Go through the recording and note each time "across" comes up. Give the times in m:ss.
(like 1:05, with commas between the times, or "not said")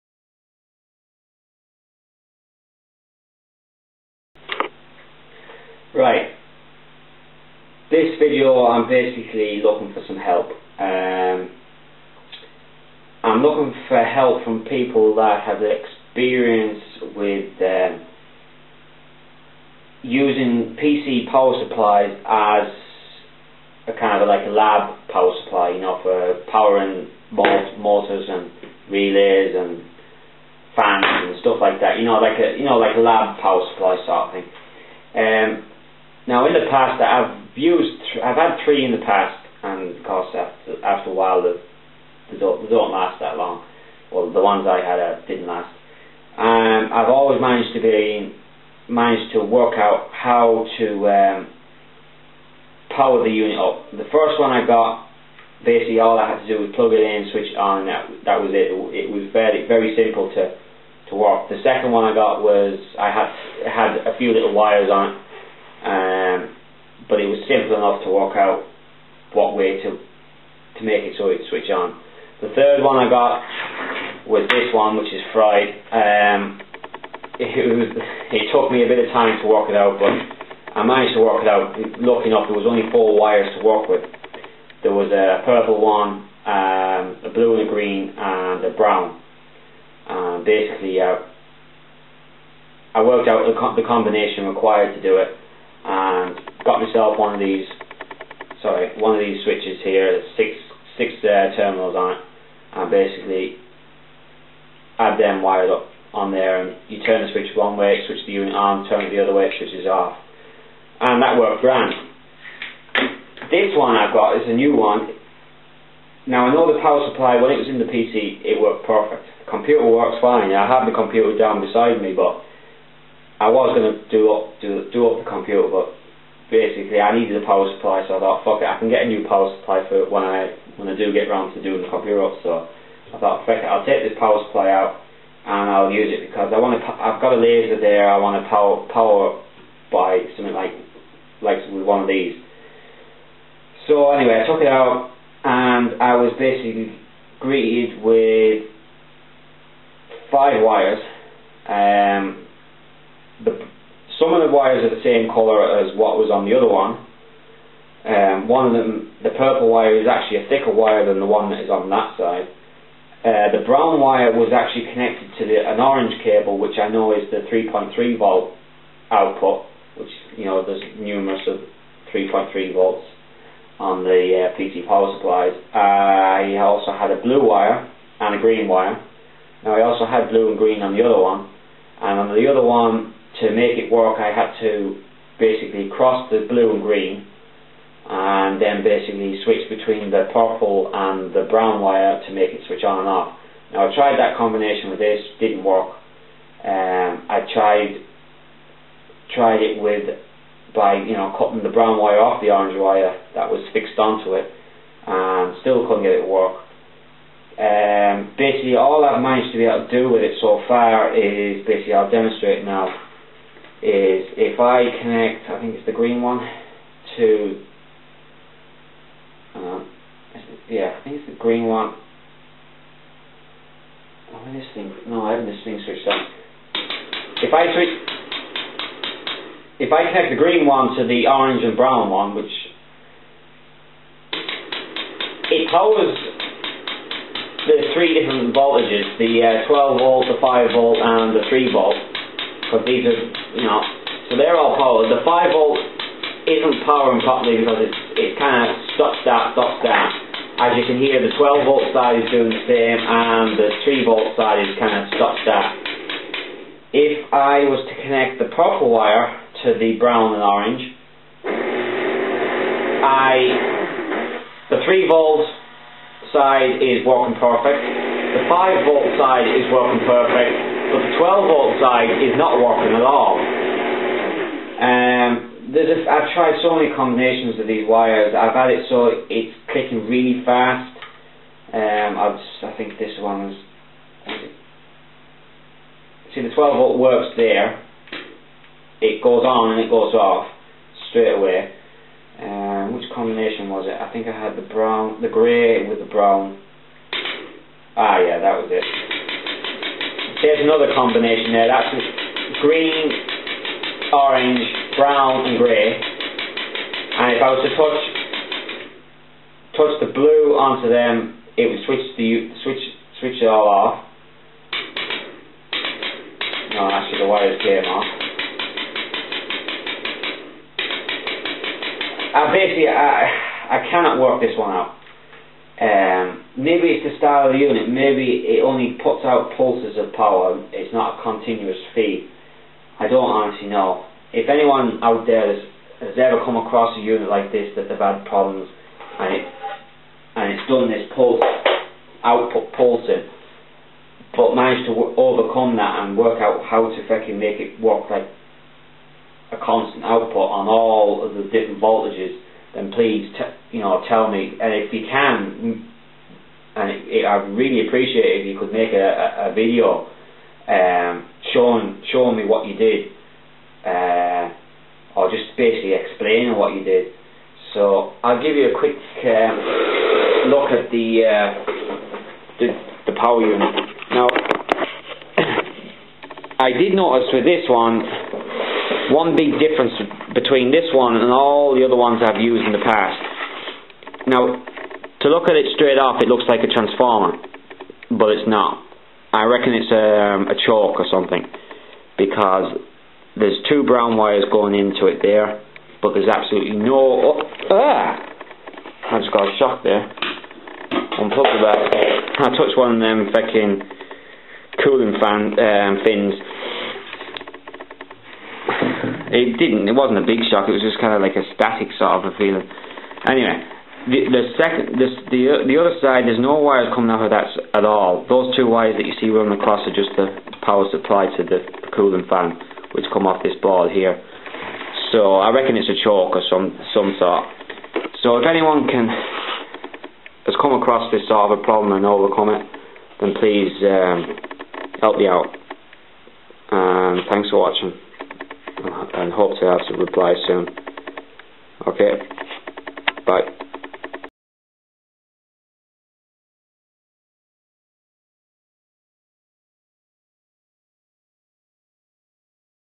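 5:36, 6:59, 7:10.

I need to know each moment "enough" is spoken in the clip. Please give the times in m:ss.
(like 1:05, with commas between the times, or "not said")
1:07, 1:22.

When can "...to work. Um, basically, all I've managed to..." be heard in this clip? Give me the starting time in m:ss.
3:26.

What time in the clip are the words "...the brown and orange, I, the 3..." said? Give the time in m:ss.
4:19.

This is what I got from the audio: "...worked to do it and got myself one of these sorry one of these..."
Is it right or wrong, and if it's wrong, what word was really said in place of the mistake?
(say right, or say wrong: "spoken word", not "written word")
wrong: "required", not "worked".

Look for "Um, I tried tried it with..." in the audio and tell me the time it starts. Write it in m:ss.
3:16.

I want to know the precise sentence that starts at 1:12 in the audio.
The third one I got was this one, which is fried.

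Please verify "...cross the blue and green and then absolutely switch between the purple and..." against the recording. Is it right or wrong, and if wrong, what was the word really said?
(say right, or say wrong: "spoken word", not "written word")
wrong: "basically", not "absolutely".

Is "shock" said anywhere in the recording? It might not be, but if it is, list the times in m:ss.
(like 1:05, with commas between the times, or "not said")
6:39, 6:50.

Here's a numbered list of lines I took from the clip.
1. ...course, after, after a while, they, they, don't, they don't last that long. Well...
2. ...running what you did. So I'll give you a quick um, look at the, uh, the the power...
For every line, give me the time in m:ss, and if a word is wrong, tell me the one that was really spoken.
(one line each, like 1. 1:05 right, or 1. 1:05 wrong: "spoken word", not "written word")
1. 0:40 right
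2. 6:05 wrong: "explaining", not "running".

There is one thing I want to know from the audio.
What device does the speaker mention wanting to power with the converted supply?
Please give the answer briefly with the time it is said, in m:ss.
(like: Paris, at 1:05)
a laser, at 2:17.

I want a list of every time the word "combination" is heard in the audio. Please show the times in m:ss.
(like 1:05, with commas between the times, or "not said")
1:33, 3:14, 4:36, 4:53, 5:00.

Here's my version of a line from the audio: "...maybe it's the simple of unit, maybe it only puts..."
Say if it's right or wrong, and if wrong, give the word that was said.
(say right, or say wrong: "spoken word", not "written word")
wrong: "style", not "simple".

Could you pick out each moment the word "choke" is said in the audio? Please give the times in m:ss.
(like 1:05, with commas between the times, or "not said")
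6:30, 7:06.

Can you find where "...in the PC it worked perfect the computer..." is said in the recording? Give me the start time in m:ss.
1:57.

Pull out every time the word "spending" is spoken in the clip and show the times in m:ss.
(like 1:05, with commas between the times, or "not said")
not said.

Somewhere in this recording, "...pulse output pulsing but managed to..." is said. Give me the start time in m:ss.
5:41.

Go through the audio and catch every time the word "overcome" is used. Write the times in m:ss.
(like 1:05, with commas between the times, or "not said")
5:45, 7:12.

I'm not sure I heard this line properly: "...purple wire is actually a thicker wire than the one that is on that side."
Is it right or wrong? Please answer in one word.
right.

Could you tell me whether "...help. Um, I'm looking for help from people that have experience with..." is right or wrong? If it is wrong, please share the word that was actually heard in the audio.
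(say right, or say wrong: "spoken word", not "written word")
right.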